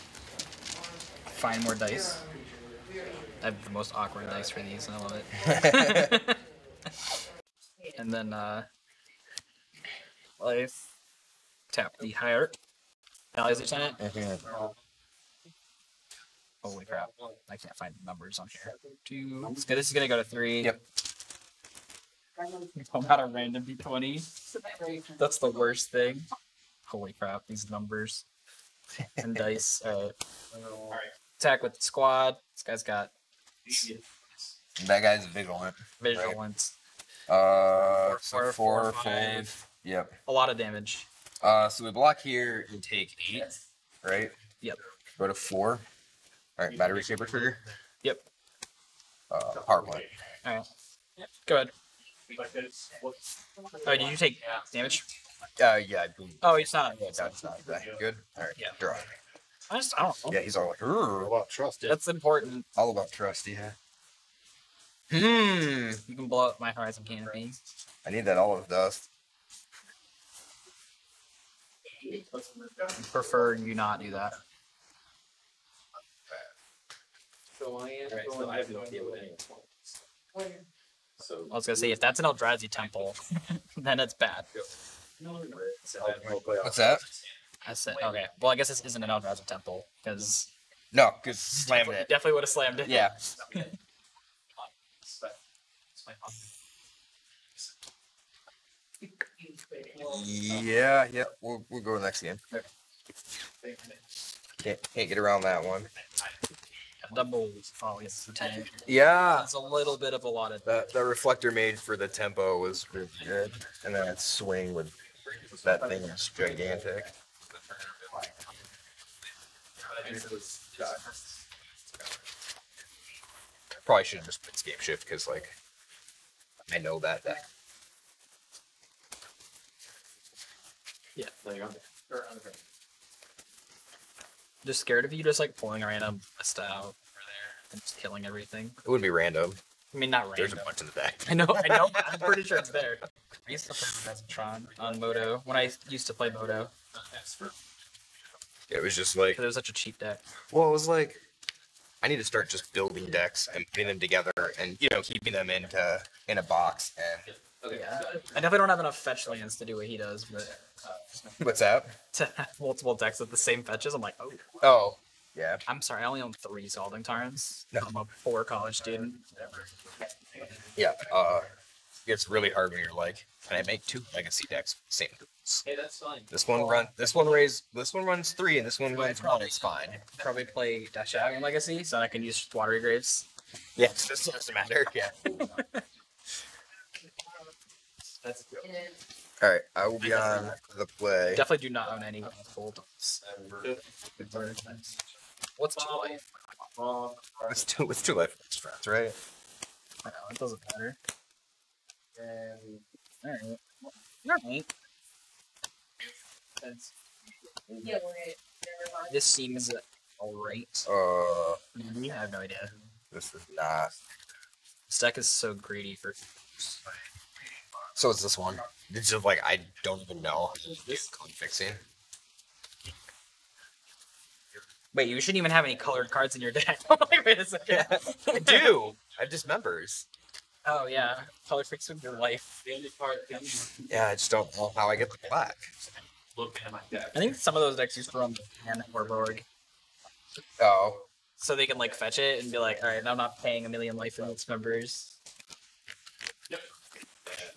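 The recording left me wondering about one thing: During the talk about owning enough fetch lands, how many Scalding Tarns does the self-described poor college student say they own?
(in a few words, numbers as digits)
3.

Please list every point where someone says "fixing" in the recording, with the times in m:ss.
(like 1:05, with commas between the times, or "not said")
3:41, 3:51.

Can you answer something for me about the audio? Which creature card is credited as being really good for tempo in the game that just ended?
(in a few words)
Reflector Mage.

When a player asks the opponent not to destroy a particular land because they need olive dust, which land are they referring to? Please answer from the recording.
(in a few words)
Horizon Canopy.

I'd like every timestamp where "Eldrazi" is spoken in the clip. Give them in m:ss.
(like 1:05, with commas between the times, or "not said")
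1:22, 1:29.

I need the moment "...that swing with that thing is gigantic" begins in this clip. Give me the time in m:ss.
1:54.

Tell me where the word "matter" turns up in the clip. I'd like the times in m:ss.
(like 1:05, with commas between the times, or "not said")
3:04, 3:20.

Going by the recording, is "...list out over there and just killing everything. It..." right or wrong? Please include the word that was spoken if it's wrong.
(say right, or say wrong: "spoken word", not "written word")
right.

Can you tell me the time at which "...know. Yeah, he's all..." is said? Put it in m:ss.
1:00.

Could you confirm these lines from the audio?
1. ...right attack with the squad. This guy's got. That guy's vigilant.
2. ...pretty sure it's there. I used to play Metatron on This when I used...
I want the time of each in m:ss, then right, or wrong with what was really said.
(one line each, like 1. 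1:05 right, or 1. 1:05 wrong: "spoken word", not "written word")
1. 0:30 right
2. 2:22 wrong: "Moto", not "This".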